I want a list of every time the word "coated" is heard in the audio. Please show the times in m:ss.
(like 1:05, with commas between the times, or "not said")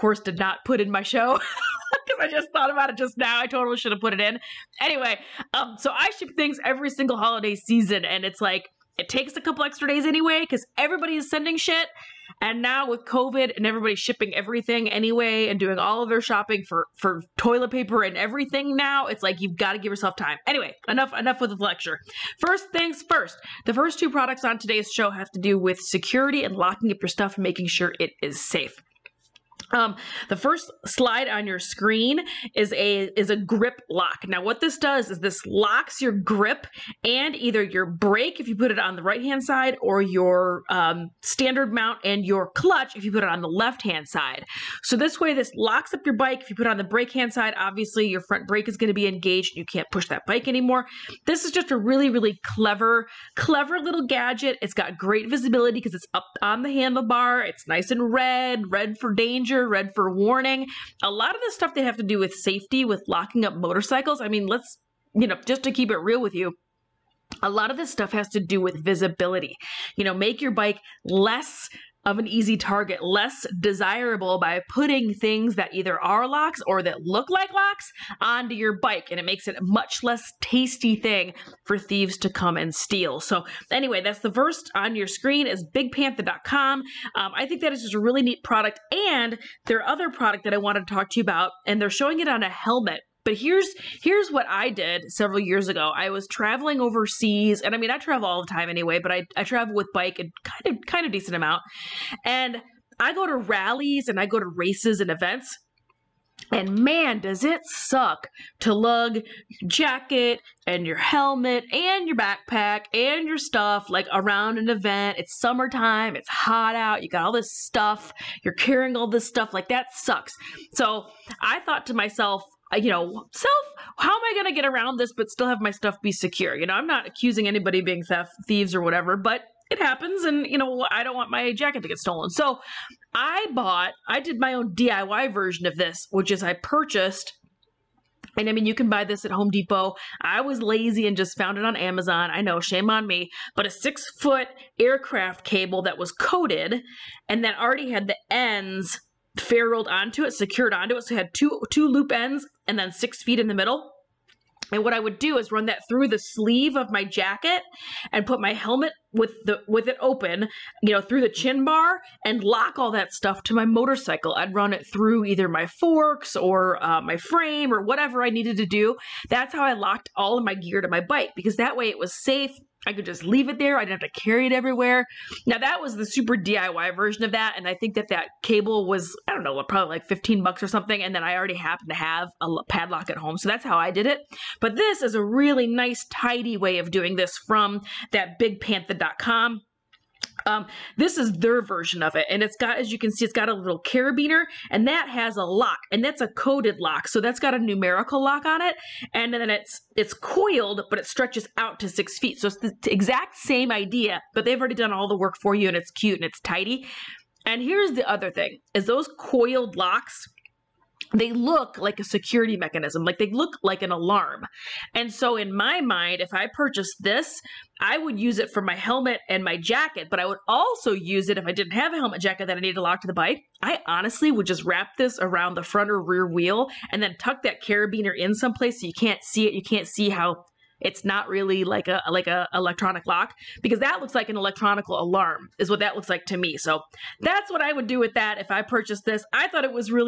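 2:26.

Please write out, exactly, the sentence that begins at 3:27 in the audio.
And here's the other thing: is those coiled locks they look like a security mechanism, like they look like an alarm.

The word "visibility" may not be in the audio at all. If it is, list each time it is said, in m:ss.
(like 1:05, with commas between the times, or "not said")
0:55, 1:08.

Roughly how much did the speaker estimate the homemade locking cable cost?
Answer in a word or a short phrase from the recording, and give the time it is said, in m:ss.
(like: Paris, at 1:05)
$15, at 3:00.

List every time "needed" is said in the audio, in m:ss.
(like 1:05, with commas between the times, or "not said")
2:48, 3:42.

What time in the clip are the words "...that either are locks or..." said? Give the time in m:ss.
1:15.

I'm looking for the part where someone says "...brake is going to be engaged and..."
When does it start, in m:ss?
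0:48.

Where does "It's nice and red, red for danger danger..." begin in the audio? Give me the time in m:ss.
0:57.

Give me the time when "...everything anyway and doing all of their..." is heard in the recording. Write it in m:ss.
0:14.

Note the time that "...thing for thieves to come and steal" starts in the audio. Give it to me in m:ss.
1:20.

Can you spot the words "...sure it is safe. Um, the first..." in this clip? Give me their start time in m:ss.
0:27.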